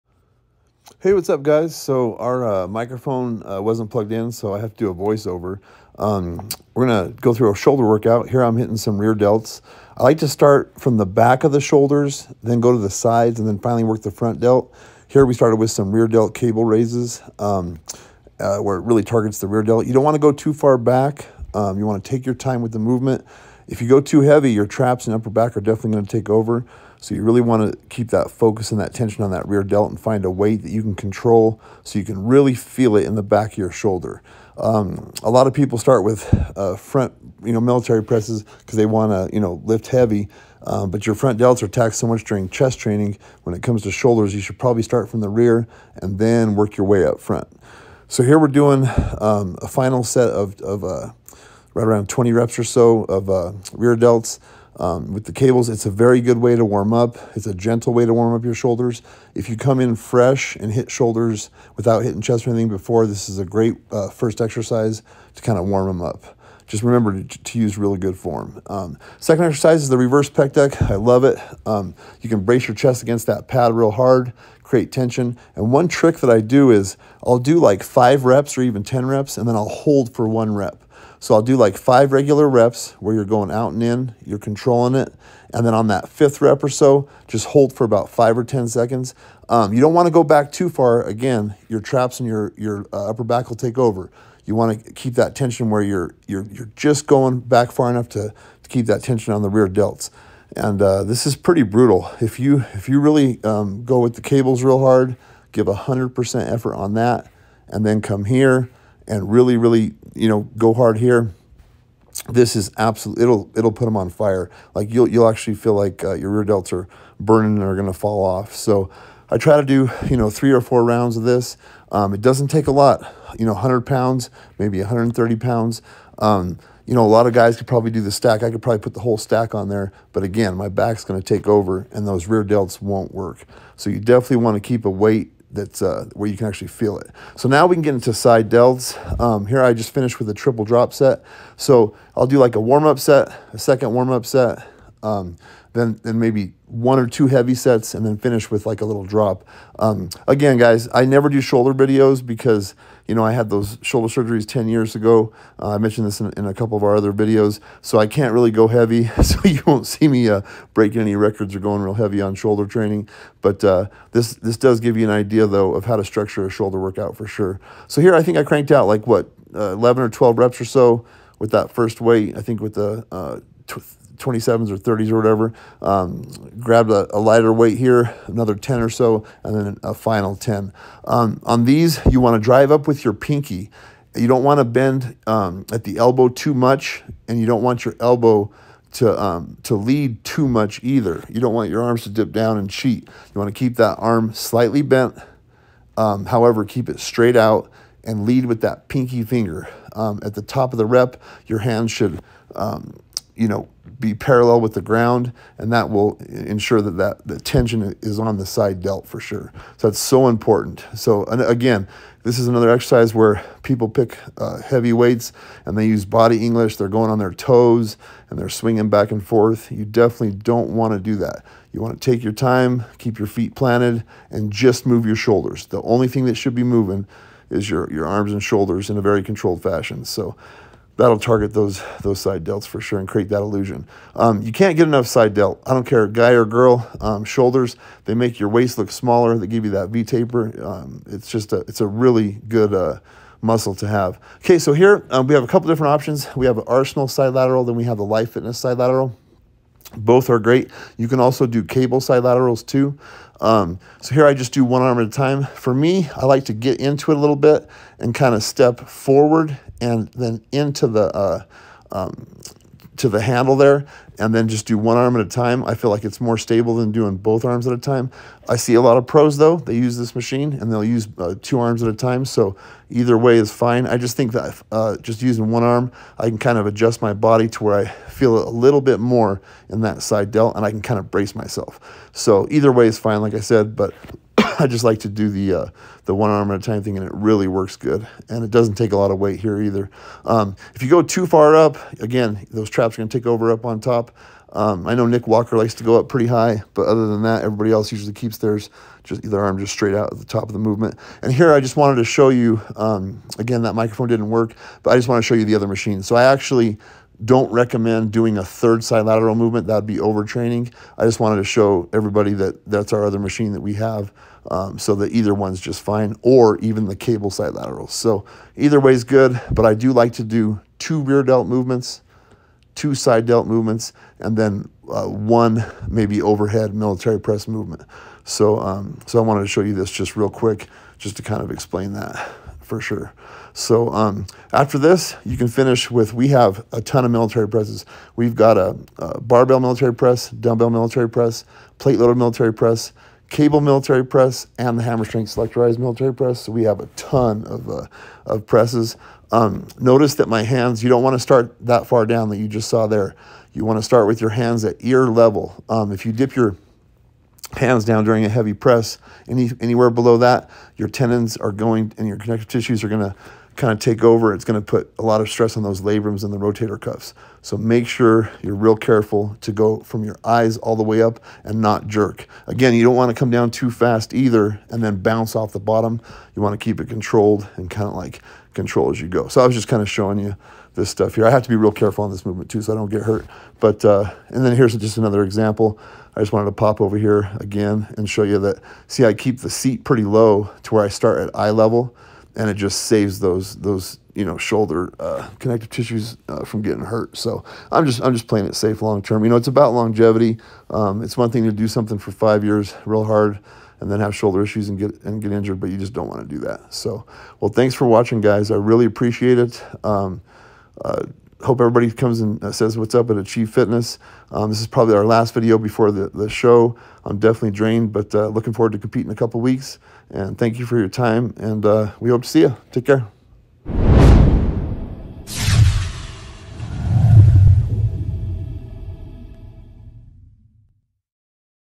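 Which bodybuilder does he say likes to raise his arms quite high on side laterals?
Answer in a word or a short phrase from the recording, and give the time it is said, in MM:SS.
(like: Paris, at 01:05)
Nick Walker, at 04:55.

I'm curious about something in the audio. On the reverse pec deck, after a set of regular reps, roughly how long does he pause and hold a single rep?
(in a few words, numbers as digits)
5 or 10 seconds.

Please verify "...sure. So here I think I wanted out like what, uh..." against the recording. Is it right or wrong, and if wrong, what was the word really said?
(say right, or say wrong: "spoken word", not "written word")
wrong: "cranked", not "wanted".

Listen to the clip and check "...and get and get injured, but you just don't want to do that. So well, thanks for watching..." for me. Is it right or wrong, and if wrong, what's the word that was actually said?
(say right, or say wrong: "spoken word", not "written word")
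right.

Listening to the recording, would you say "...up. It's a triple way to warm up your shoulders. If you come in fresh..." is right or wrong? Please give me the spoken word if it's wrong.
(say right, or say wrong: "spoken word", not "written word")
wrong: "gentle", not "triple".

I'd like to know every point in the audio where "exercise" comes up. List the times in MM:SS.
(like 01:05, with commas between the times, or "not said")
01:04, 01:09, 03:32.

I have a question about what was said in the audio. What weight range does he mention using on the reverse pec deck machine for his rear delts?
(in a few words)
100 to 130 pounds.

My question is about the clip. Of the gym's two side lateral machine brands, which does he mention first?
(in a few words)
Arsenal.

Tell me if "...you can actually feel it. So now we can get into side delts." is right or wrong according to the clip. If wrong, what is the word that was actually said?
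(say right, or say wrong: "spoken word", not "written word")
right.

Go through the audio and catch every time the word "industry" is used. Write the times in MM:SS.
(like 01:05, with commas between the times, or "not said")
not said.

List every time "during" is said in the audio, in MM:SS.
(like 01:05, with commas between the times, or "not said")
00:42, 05:58.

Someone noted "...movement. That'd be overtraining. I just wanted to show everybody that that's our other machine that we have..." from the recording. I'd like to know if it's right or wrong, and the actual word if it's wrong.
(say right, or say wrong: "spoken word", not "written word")
right.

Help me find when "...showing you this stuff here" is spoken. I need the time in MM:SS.
06:19.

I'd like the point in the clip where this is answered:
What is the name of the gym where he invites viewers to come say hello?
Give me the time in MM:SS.
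06:53.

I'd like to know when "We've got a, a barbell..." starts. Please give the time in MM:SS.
05:38.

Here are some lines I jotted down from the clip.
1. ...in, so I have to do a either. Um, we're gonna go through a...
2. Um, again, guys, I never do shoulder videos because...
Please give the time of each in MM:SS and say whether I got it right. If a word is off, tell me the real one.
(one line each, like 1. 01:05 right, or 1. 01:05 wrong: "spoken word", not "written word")
1. 00:04 wrong: "voiceover", not "either"
2. 02:29 right.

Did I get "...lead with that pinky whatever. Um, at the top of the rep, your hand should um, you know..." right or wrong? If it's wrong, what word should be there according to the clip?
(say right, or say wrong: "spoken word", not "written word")
wrong: "finger", not "whatever".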